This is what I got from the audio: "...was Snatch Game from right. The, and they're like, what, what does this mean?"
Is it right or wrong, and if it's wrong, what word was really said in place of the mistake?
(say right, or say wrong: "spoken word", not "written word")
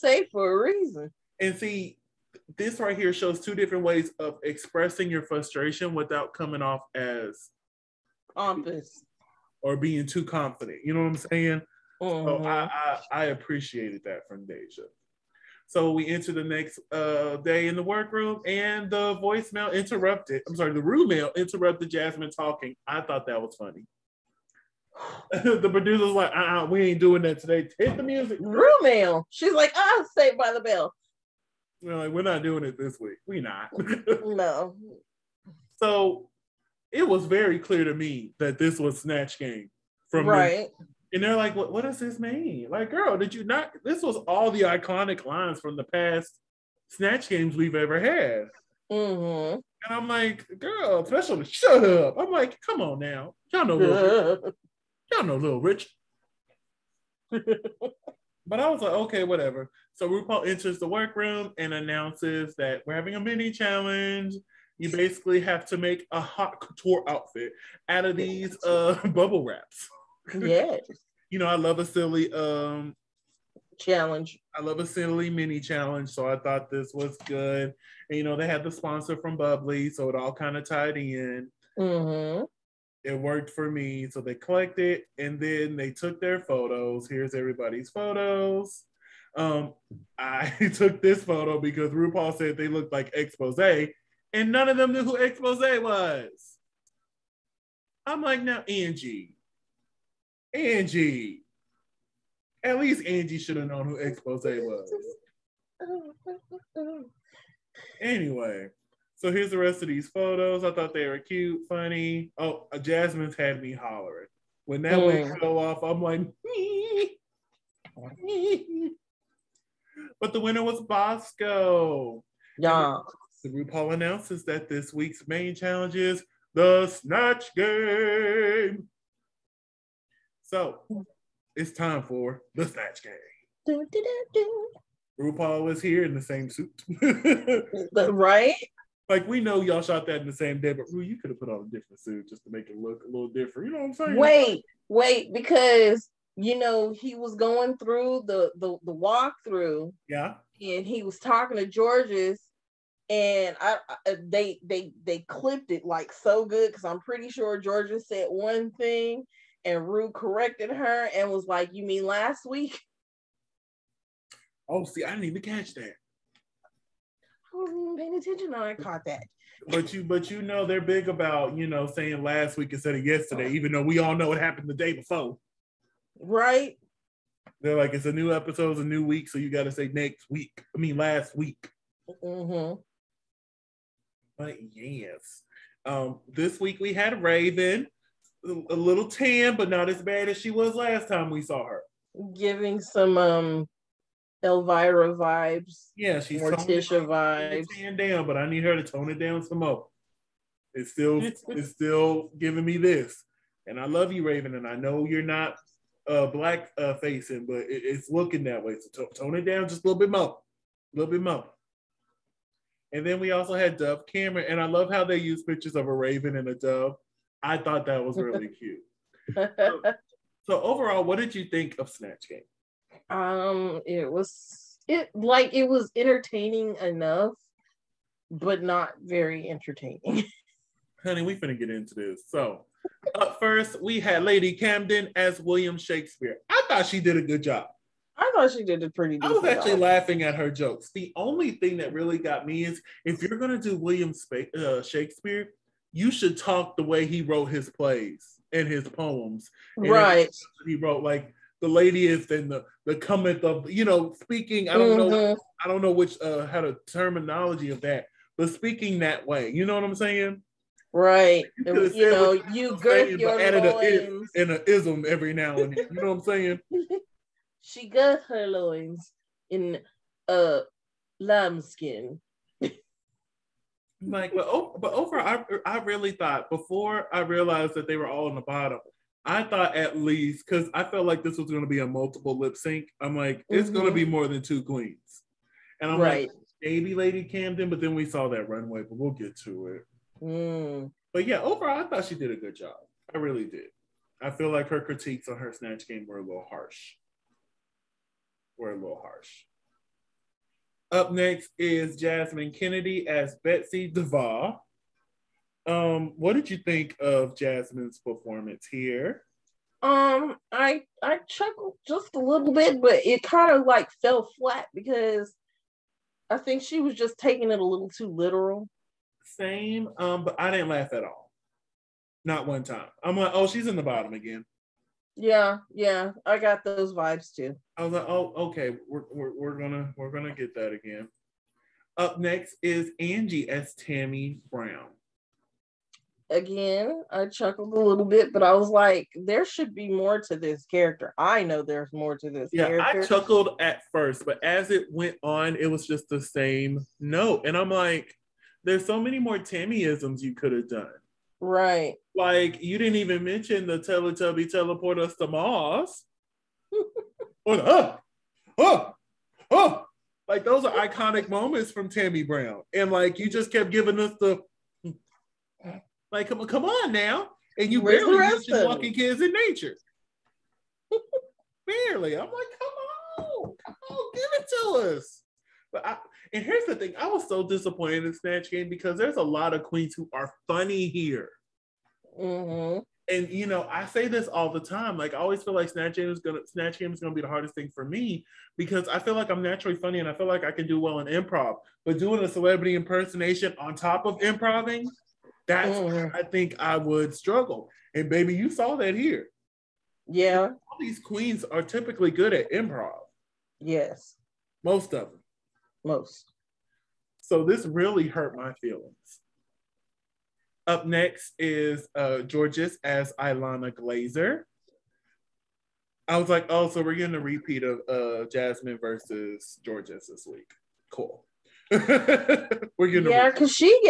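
right.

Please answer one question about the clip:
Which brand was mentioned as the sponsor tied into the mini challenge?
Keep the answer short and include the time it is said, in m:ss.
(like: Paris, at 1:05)
bubly, at 1:19.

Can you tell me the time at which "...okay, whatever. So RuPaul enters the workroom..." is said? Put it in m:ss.
0:58.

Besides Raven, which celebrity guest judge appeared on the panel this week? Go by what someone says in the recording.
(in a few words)
Dove Cameron.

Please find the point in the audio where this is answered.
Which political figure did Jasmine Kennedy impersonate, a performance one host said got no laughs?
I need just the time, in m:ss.
5:03.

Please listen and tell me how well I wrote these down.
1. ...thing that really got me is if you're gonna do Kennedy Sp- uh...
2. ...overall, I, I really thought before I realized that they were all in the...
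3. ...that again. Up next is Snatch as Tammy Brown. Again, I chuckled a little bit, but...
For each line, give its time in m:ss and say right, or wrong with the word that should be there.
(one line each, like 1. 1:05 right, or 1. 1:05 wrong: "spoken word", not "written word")
1. 4:01 wrong: "William", not "Kennedy"
2. 4:34 right
3. 5:30 wrong: "Angie", not "Snatch".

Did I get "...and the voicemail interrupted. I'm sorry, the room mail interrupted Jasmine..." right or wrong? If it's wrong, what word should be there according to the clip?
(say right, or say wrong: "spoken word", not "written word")
right.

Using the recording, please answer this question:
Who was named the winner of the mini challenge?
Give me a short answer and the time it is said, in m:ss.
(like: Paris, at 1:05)
Bosco, at 2:00.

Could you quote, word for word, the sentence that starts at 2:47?
I wasn't even paying attention when I caught that.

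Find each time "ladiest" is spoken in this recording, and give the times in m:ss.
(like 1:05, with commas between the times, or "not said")
4:11.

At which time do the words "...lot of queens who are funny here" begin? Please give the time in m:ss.
6:19.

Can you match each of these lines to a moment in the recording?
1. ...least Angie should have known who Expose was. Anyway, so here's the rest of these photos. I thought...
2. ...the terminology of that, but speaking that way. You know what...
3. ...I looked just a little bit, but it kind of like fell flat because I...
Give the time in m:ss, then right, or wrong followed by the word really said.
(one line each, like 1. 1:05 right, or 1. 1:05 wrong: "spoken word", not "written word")
1. 1:42 right
2. 4:16 right
3. 5:11 wrong: "chuckled", not "looked".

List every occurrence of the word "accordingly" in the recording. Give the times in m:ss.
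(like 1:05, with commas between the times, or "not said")
not said.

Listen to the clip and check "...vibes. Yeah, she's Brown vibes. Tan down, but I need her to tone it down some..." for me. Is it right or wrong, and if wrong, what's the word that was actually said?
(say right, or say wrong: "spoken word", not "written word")
wrong: "Morticia", not "Brown".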